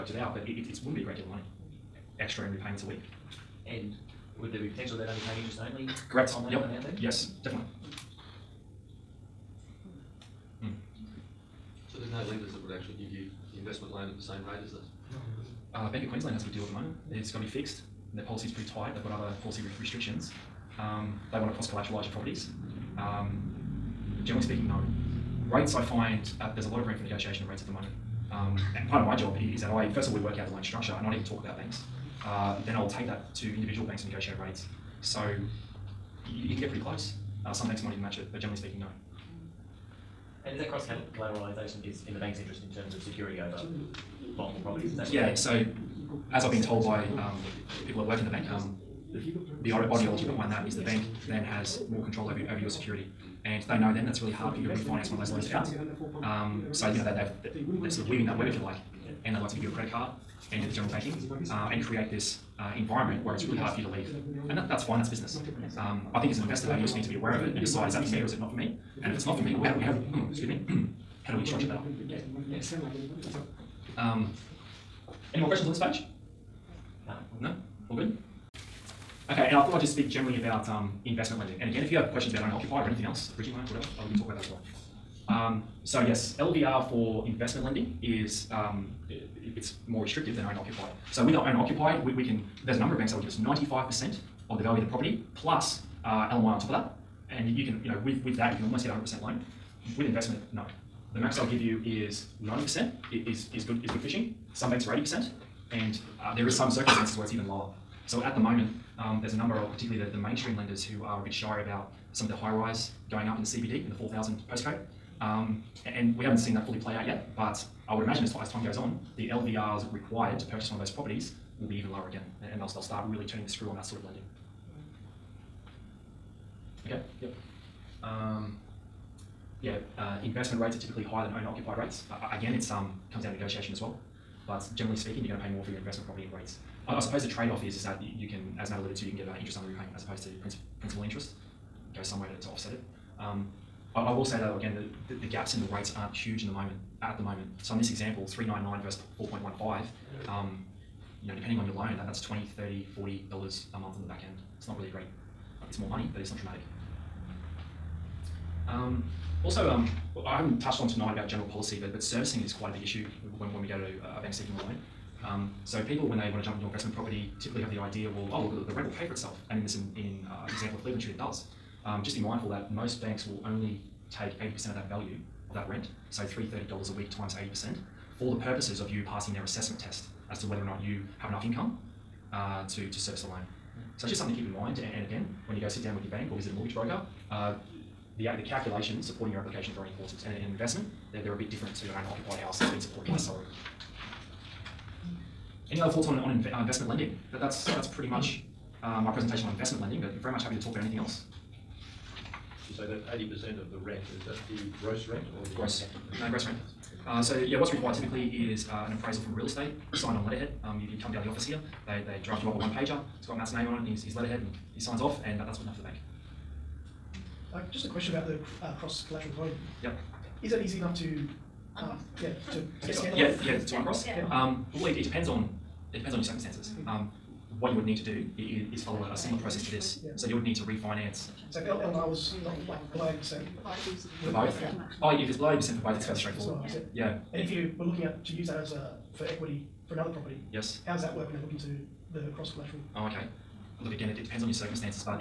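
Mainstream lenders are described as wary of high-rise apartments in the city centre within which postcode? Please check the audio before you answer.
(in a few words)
4000.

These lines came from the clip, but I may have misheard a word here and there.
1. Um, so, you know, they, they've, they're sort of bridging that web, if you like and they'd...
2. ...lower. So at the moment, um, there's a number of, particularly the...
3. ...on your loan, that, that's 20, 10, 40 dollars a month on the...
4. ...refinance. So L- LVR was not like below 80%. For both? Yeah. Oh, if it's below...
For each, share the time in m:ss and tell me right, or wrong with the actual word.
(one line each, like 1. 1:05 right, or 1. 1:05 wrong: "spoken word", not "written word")
1. 0:56 wrong: "weaving", not "bridging"
2. 1:47 right
3. 2:31 wrong: "30", not "10"
4. 3:50 right.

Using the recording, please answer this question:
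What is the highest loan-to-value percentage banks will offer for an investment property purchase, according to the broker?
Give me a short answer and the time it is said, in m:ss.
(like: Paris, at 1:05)
90%, at 1:42.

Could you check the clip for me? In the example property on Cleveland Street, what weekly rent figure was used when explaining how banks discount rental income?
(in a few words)
$330.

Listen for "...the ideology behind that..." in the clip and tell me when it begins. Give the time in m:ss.
0:49.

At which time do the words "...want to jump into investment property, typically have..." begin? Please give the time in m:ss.
2:46.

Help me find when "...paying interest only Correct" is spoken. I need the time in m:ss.
0:05.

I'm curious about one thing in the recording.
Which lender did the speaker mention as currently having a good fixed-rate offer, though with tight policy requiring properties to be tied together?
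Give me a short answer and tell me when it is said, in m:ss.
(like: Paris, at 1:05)
Bank of Queensland, at 0:15.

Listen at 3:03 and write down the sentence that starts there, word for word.
So it's just something to keep in mind.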